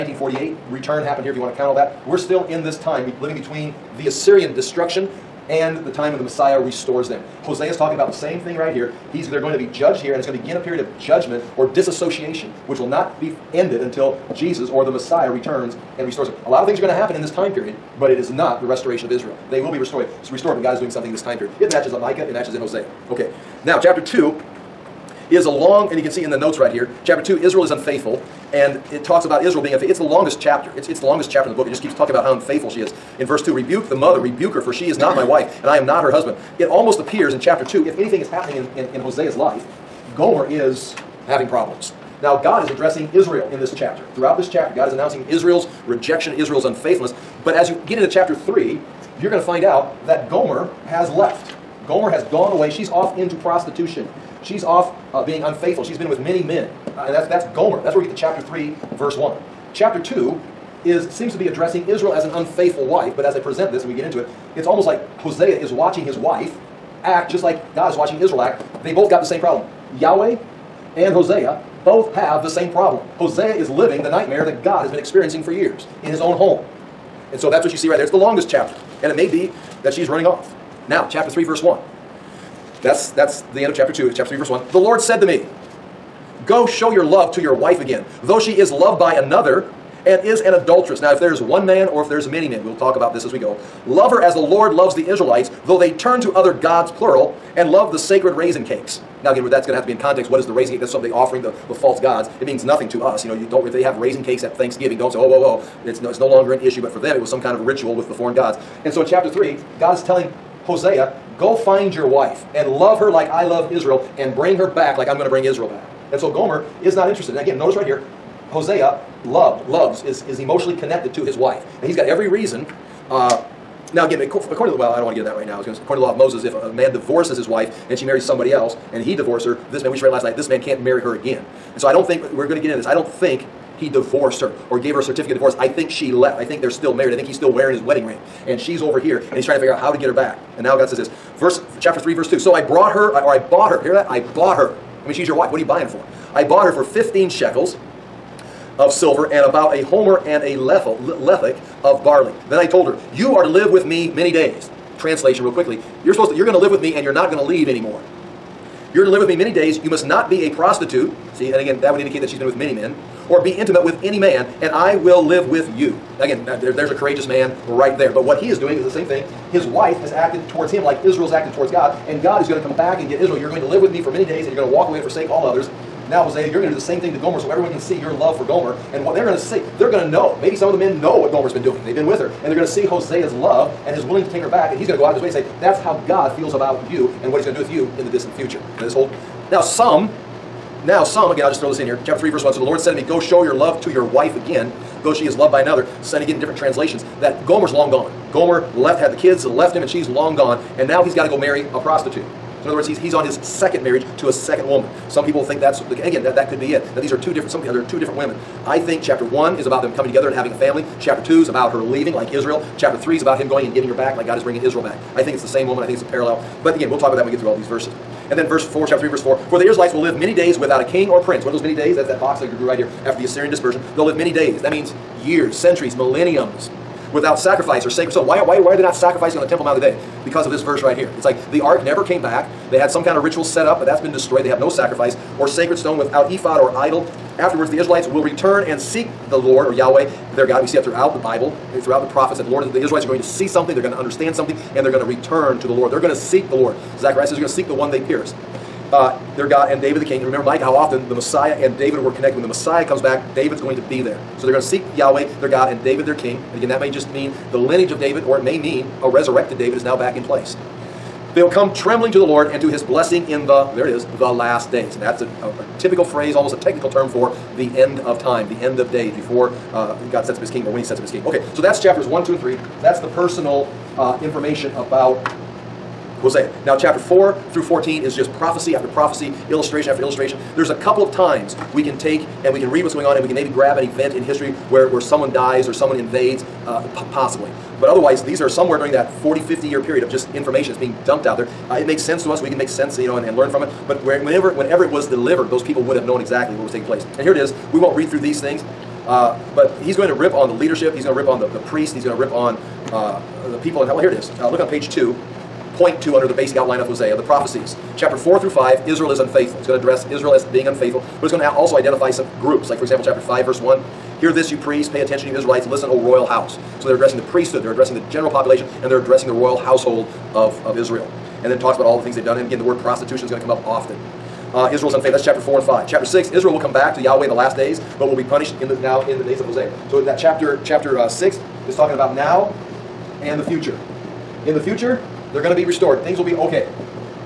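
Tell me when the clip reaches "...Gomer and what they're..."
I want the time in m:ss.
2:58.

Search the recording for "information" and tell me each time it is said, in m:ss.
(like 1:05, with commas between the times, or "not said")
4:34, 4:50.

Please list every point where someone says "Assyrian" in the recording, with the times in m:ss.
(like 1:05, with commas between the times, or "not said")
0:04, 3:43.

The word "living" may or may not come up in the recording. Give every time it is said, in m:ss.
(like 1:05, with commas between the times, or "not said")
0:03, 1:13.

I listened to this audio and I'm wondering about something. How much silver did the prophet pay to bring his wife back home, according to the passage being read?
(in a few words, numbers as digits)
15 shekels.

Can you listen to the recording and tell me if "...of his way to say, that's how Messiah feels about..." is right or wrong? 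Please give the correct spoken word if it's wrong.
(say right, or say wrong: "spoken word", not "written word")
wrong: "God", not "Messiah".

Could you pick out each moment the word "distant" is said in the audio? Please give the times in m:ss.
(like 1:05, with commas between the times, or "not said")
3:08.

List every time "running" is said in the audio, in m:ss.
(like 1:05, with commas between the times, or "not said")
1:20.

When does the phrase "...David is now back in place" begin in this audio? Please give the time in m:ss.
4:19.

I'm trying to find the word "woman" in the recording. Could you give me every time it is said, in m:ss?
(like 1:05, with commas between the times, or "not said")
3:24, 3:35.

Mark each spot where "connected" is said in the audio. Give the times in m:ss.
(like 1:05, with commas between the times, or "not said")
2:00, 4:12.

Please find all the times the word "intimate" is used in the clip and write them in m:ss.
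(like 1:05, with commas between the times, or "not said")
2:43.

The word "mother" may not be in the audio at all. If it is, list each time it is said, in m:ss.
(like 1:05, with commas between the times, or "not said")
0:33.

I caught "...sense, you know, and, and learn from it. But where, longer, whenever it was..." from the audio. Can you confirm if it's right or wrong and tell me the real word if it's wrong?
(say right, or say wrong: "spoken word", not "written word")
wrong: "whenever", not "longer".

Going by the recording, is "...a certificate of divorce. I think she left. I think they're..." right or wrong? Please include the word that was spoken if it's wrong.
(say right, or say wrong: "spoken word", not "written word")
right.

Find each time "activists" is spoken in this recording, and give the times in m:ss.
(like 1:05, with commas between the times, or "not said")
not said.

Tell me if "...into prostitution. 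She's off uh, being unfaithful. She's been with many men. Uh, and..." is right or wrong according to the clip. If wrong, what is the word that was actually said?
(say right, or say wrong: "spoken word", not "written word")
right.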